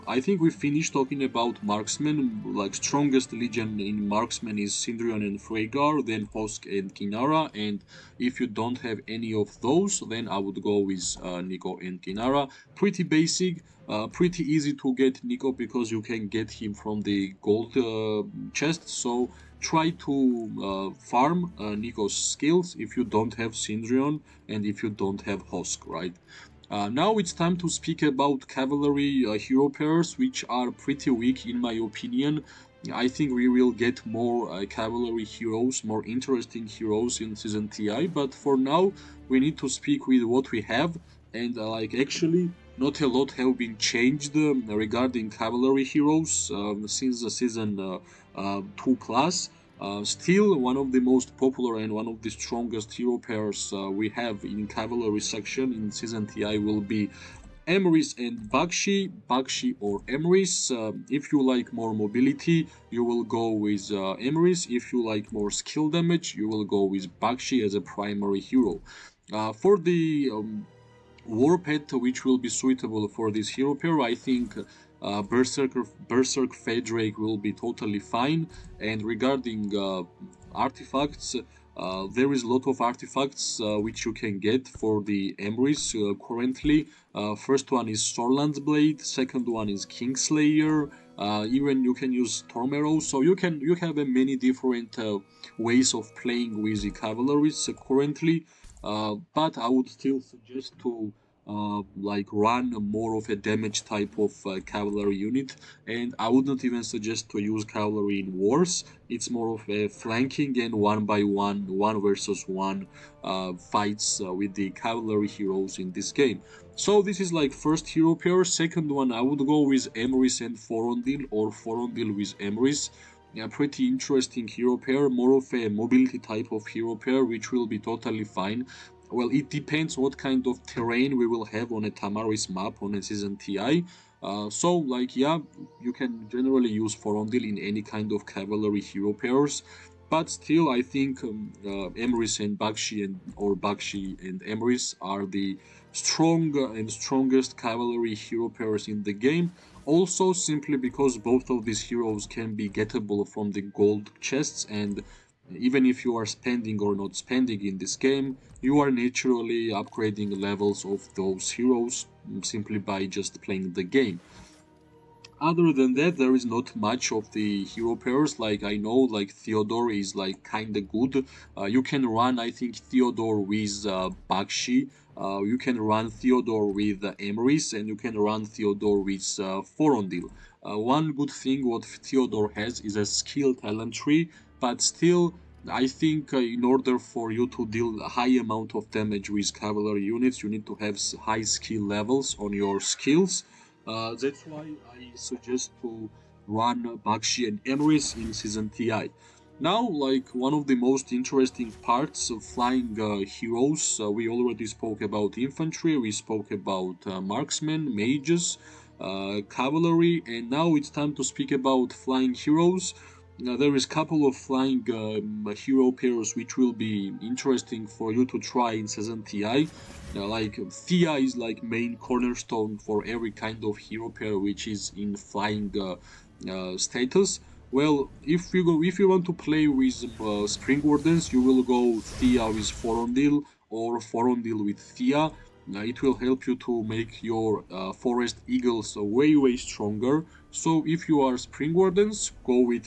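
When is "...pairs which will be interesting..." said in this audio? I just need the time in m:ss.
3:35.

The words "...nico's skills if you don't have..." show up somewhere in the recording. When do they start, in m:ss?
0:21.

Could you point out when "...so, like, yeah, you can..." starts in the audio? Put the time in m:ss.
2:14.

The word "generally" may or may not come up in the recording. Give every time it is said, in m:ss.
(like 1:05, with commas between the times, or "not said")
2:16.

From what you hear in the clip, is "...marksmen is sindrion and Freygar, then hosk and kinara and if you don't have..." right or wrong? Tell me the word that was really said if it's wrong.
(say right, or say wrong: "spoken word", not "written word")
right.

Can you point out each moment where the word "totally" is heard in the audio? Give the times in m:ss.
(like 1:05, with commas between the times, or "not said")
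1:17, 2:07.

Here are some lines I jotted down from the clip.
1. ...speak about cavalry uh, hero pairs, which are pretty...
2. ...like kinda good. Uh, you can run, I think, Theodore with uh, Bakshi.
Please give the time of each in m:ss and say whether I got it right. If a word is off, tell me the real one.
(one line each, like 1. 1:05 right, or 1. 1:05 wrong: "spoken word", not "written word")
1. 0:27 right
2. 2:50 right.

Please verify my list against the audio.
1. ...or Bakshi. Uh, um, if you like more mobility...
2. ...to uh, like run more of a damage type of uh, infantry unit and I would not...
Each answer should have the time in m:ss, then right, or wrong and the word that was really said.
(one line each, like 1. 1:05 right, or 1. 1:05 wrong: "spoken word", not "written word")
1. 0:59 wrong: "Emrys", not "Bakshi"
2. 1:40 wrong: "cavalry", not "infantry".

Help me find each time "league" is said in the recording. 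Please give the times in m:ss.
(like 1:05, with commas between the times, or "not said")
not said.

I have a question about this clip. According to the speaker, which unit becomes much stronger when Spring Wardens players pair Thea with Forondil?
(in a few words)
Forest Eagles.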